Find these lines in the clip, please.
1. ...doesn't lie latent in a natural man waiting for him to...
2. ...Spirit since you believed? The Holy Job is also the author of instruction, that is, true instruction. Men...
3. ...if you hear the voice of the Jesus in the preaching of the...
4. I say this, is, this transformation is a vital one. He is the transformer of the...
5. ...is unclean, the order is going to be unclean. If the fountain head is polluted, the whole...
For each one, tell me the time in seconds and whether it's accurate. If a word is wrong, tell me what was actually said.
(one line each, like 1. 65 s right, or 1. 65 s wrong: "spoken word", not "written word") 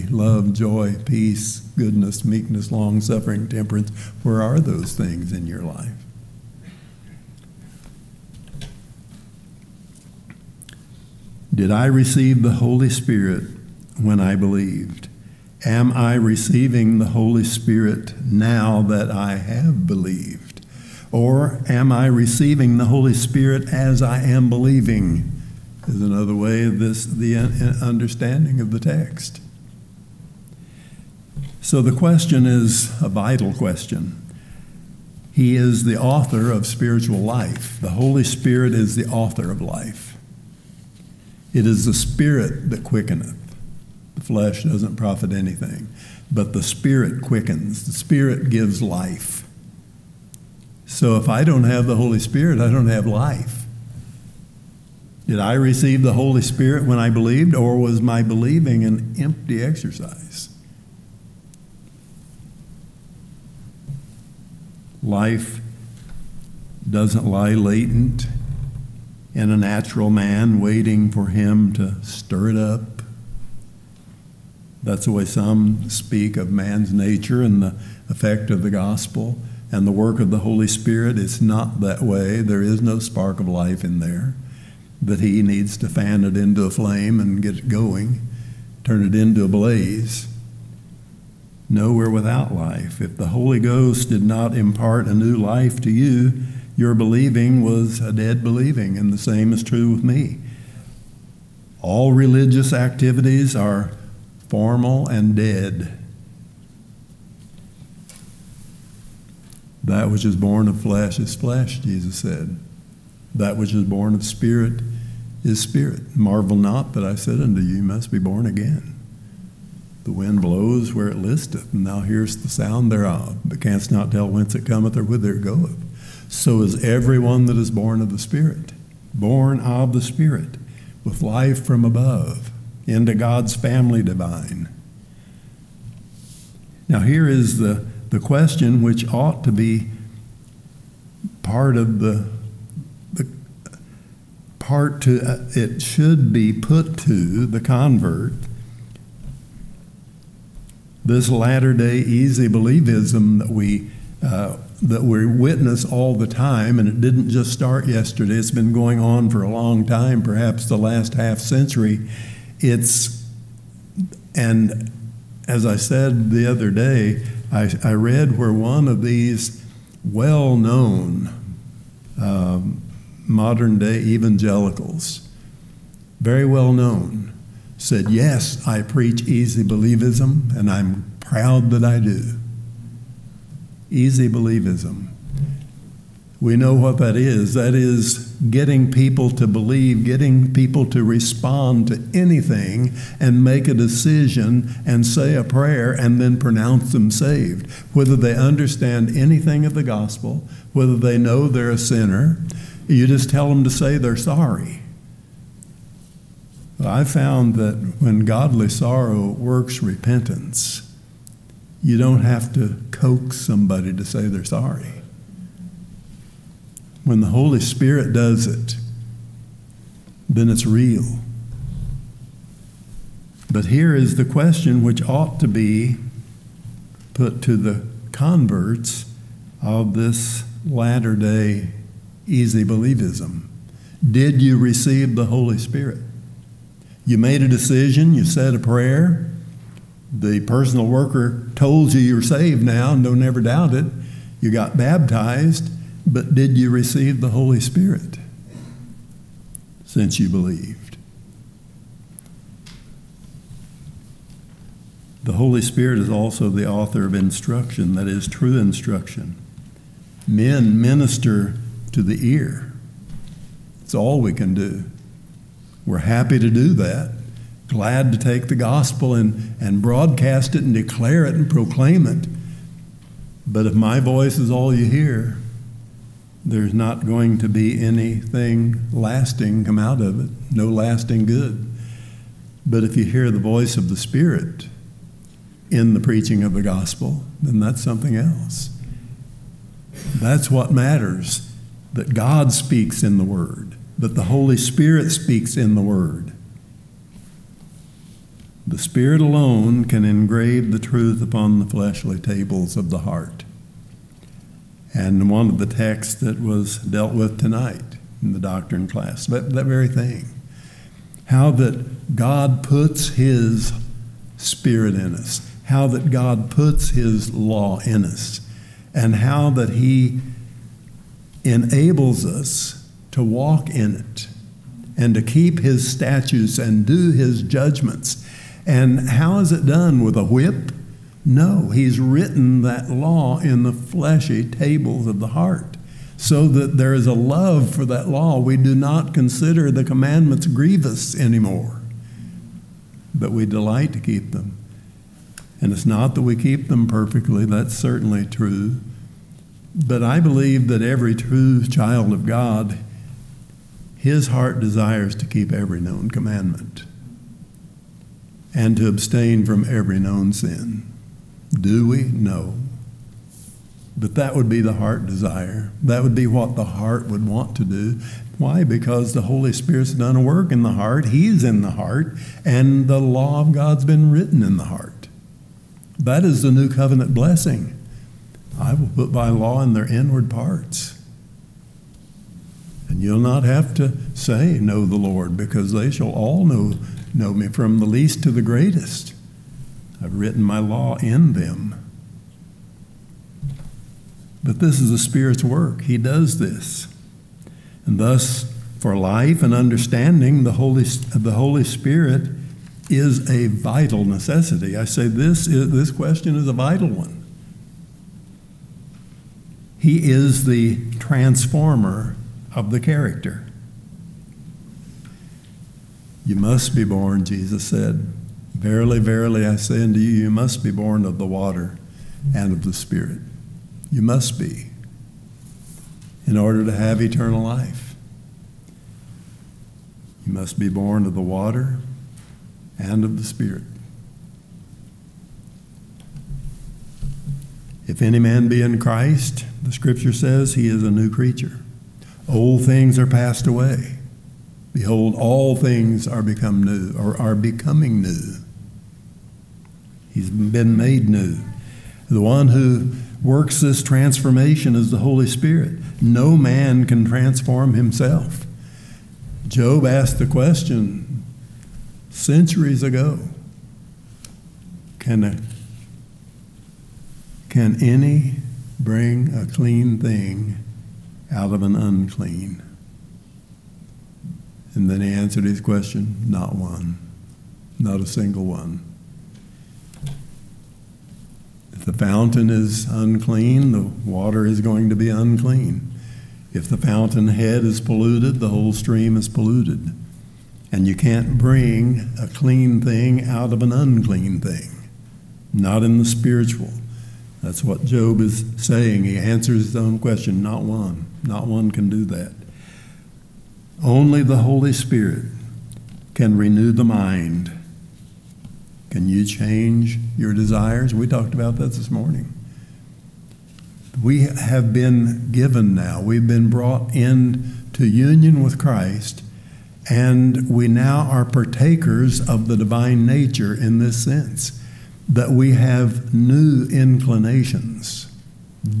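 1. 66 s right
2. 247 s wrong: "Spirit", not "Job"
3. 282 s wrong: "Spirit", not "Jesus"
4. 404 s wrong: "question", not "transformation"
5. 482 s wrong: "water", not "order".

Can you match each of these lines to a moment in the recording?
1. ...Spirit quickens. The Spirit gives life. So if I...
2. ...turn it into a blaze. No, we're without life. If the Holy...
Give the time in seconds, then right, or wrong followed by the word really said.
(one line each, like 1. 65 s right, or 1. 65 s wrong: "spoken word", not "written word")
1. 46 s right
2. 88 s right.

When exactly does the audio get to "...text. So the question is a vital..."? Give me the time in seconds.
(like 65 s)
28 s.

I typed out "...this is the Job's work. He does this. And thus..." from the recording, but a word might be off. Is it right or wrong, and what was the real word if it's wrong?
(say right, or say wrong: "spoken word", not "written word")
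wrong: "Spirit", not "Job".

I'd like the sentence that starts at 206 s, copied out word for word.
I found that when godly sorrow works repentance, you don't have to coax somebody to say they're sorry.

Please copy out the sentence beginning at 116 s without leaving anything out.
Marvel not that I said unto you, you must be born again.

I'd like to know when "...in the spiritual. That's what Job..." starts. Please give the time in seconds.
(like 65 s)
495 s.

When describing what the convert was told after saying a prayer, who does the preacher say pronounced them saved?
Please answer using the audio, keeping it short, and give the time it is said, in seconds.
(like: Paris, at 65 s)
the personal worker, at 240 s.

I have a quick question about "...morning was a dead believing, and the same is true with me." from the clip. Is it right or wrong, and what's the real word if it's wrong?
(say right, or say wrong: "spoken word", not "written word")
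wrong: "believing", not "morning".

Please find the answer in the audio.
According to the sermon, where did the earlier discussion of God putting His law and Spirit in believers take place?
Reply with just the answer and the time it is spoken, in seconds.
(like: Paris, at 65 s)
the doctrine class, at 308 s.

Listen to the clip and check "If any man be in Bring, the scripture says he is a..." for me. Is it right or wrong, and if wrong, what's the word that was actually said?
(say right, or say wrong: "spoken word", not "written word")
wrong: "Christ", not "Bring".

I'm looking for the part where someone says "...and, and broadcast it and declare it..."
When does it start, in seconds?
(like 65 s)
269 s.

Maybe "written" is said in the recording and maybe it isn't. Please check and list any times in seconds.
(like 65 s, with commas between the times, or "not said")
331 s, 374 s, 390 s.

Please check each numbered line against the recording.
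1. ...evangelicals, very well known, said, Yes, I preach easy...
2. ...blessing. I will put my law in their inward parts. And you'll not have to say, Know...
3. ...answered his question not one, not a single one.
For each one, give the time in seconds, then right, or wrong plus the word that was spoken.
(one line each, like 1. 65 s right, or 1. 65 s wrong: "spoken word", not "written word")
1. 173 s right
2. 377 s right
3. 475 s right.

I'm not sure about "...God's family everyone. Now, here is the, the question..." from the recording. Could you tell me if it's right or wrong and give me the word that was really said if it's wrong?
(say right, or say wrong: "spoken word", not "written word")
wrong: "divine", not "everyone".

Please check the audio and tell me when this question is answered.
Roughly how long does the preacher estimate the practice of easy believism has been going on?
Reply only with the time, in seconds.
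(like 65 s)
160 s.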